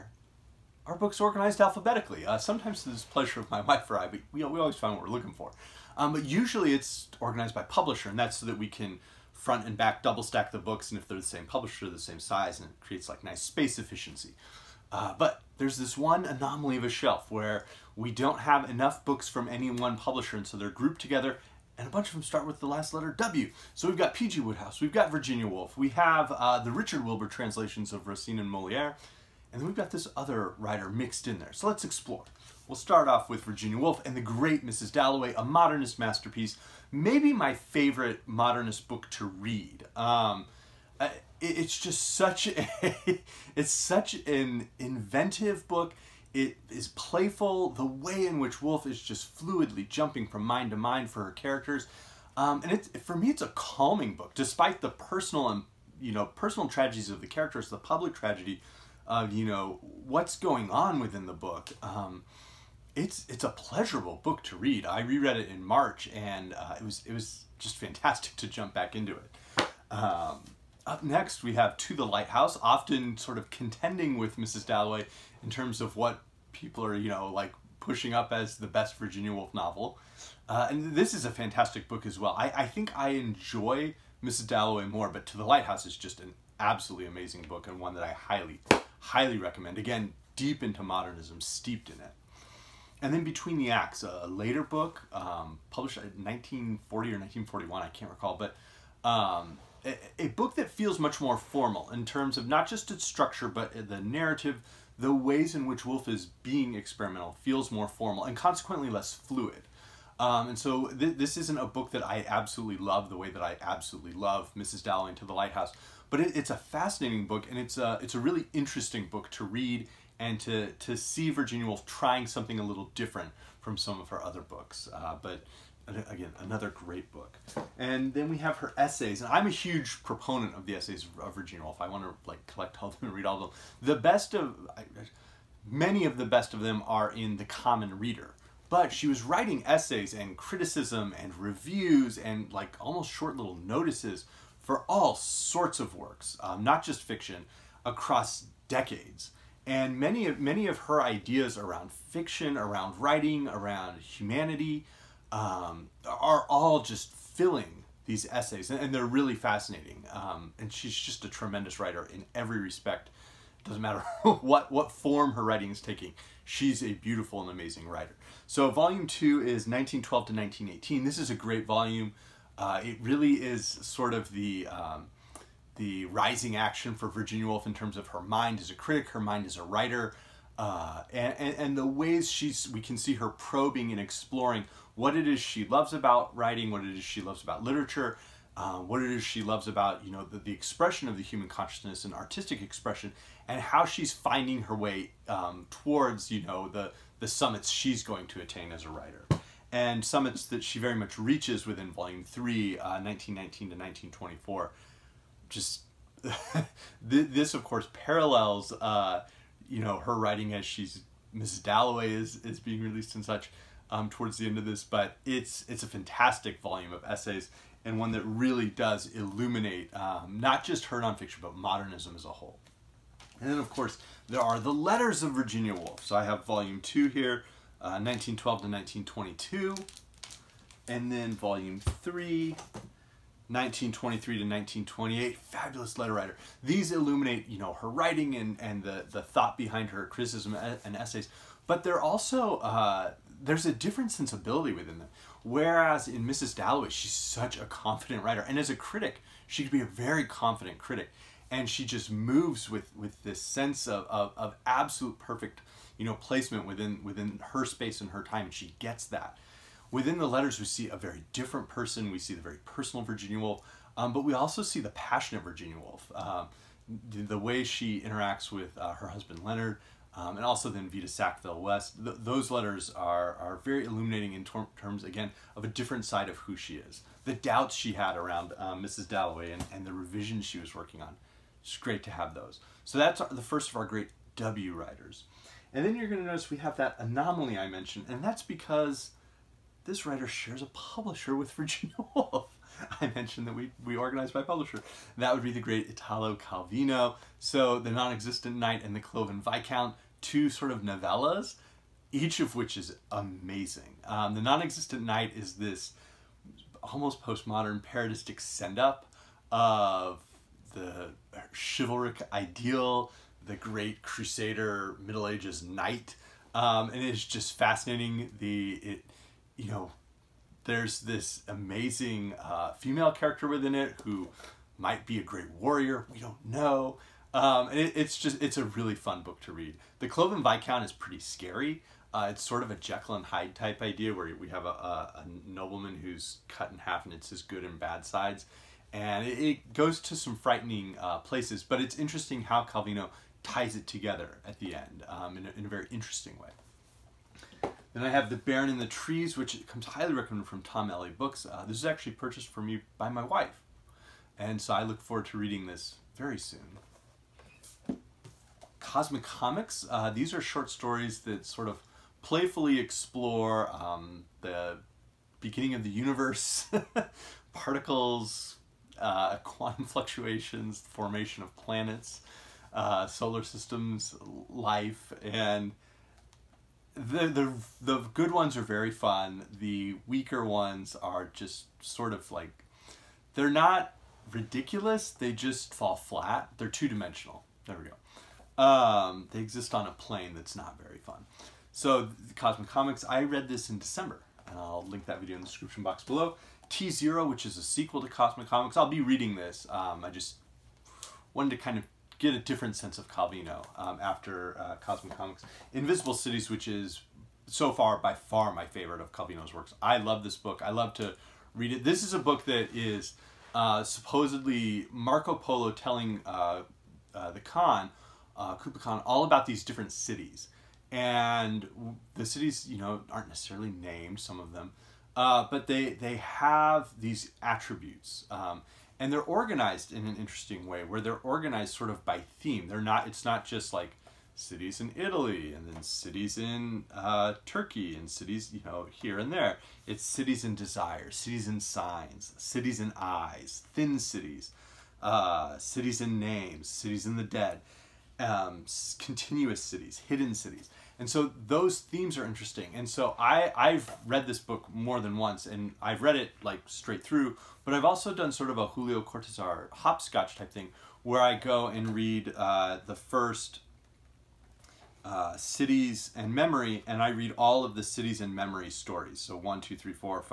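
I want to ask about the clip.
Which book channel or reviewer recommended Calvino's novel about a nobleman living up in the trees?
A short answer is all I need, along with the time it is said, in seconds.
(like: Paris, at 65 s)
Tom Alley Books, at 350 s.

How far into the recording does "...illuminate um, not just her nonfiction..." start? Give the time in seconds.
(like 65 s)
219 s.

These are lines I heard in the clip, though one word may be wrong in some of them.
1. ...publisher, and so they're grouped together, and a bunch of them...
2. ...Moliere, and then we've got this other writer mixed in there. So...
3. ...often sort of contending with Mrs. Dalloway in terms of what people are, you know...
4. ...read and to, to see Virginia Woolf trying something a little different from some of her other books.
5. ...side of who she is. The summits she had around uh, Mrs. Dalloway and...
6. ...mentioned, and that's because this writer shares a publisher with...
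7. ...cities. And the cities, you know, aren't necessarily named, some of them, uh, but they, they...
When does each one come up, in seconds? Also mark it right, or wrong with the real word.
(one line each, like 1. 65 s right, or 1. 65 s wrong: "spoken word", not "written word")
1. 19 s right
2. 28 s right
3. 72 s right
4. 119 s right
5. 276 s wrong: "doubts", not "summits"
6. 287 s right
7. 419 s right.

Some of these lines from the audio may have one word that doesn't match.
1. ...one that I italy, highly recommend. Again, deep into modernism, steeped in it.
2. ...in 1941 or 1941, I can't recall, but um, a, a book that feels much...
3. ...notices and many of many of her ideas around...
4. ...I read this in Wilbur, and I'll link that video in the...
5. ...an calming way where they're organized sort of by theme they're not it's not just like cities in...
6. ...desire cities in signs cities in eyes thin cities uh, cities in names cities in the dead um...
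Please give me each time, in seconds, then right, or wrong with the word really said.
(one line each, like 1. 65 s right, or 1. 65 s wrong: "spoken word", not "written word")
1. 87 s wrong: "highly", not "italy"
2. 95 s wrong: "1940", not "1941"
3. 148 s wrong: "decades", not "notices"
4. 393 s wrong: "December", not "Wilbur"
5. 430 s wrong: "interesting", not "calming"
6. 440 s right.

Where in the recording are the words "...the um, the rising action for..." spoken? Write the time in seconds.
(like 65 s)
174 s.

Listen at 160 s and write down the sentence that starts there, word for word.
Um, and she's just a tremendous writer in every respect.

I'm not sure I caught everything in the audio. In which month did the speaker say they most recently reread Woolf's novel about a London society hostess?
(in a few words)
March.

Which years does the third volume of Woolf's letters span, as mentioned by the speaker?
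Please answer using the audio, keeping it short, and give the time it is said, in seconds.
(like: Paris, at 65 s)
1923 to 1928, at 233 s.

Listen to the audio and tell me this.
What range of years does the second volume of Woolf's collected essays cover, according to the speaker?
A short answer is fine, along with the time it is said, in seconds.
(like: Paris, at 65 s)
1912 to 1918, at 169 s.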